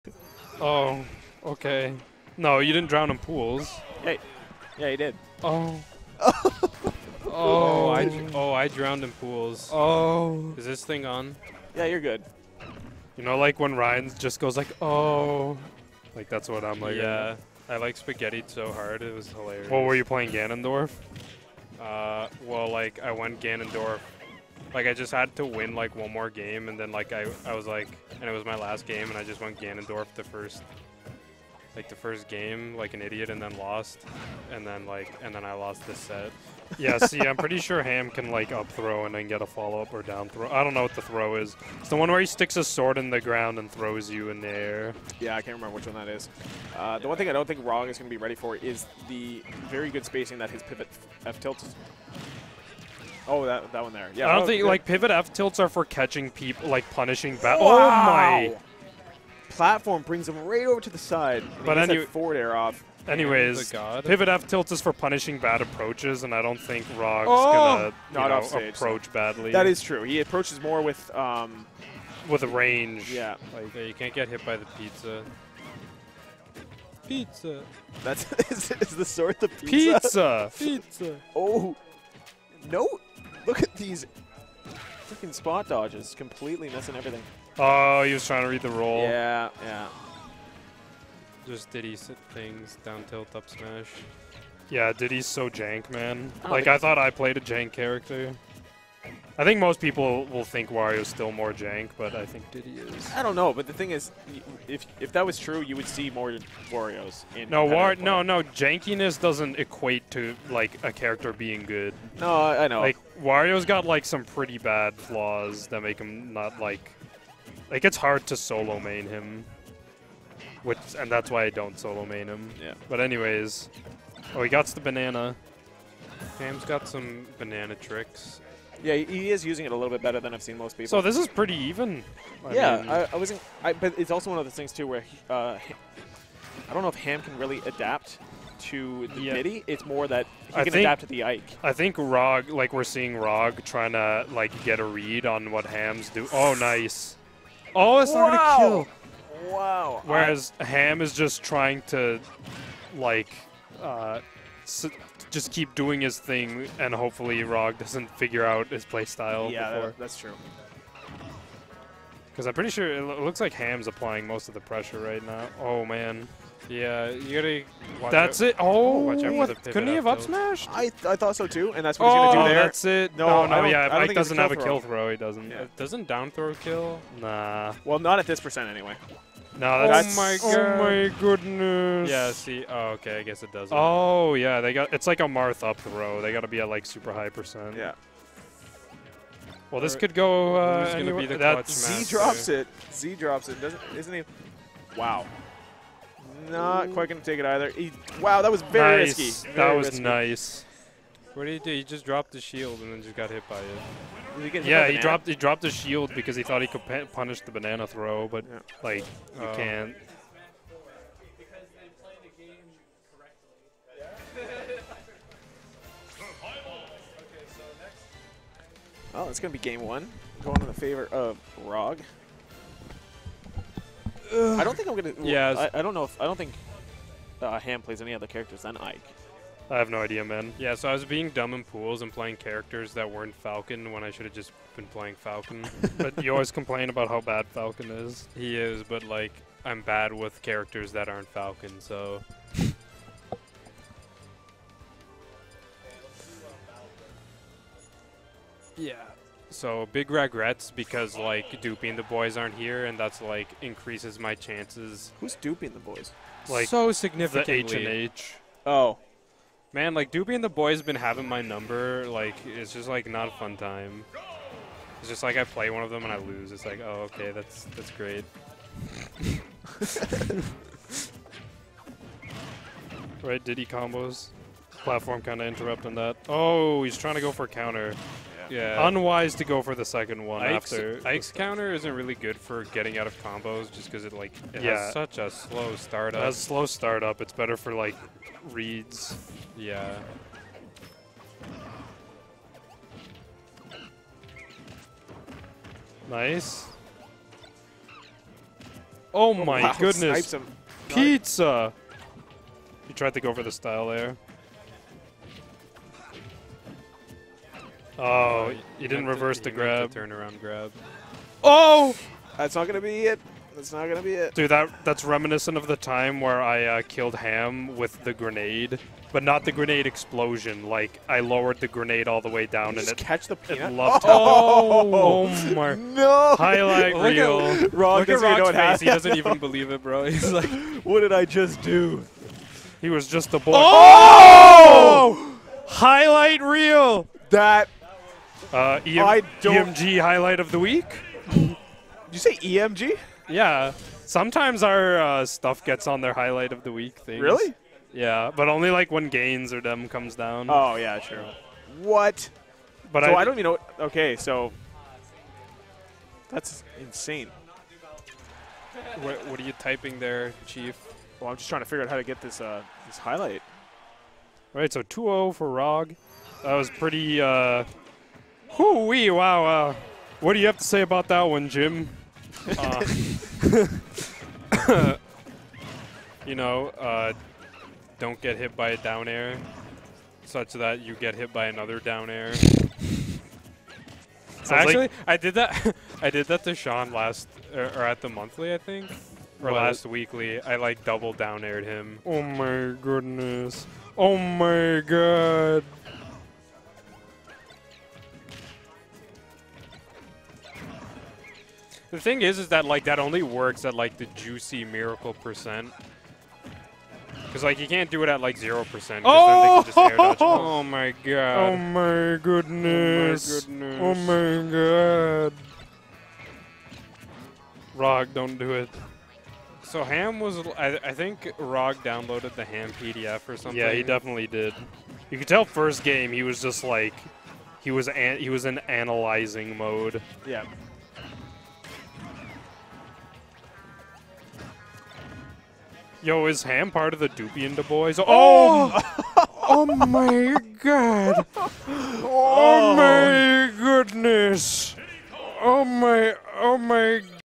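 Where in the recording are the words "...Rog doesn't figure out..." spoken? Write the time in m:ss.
2:37.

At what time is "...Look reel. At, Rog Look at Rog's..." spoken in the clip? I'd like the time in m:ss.
5:26.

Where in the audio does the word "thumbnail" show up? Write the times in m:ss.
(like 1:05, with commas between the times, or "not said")
not said.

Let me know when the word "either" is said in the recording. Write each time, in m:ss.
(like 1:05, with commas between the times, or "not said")
3:17.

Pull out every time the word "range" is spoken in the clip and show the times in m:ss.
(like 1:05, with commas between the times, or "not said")
1:12.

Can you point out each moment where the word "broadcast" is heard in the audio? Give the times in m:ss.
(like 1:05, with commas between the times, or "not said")
not said.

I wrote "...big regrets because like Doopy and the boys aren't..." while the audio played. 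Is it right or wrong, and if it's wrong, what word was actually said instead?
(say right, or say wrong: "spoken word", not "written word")
right.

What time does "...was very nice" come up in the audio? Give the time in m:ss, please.
3:18.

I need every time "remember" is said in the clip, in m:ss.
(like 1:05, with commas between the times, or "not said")
0:45.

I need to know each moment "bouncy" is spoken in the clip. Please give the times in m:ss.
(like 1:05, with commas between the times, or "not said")
not said.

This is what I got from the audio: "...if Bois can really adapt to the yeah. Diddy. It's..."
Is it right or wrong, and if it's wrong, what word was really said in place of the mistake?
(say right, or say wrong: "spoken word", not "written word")
wrong: "Ham", not "Bois".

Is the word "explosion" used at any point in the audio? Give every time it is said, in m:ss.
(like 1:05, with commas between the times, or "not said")
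5:19.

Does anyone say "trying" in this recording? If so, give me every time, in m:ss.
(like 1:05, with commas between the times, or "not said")
1:28, 2:23, 2:31, 4:36, 6:01.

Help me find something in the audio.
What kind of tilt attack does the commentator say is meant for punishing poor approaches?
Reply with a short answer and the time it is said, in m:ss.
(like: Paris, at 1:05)
Pivot F-tilt, at 1:04.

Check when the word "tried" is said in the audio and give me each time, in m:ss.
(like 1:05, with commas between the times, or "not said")
5:02.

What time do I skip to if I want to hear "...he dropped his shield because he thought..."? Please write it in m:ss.
3:25.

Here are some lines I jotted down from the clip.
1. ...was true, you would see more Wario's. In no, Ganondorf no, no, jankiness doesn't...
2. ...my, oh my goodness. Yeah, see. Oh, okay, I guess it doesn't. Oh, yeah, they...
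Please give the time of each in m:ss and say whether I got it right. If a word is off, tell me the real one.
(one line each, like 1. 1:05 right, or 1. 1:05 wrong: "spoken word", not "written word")
1. 1:45 wrong: "War", not "Ganondorf"
2. 3:00 right.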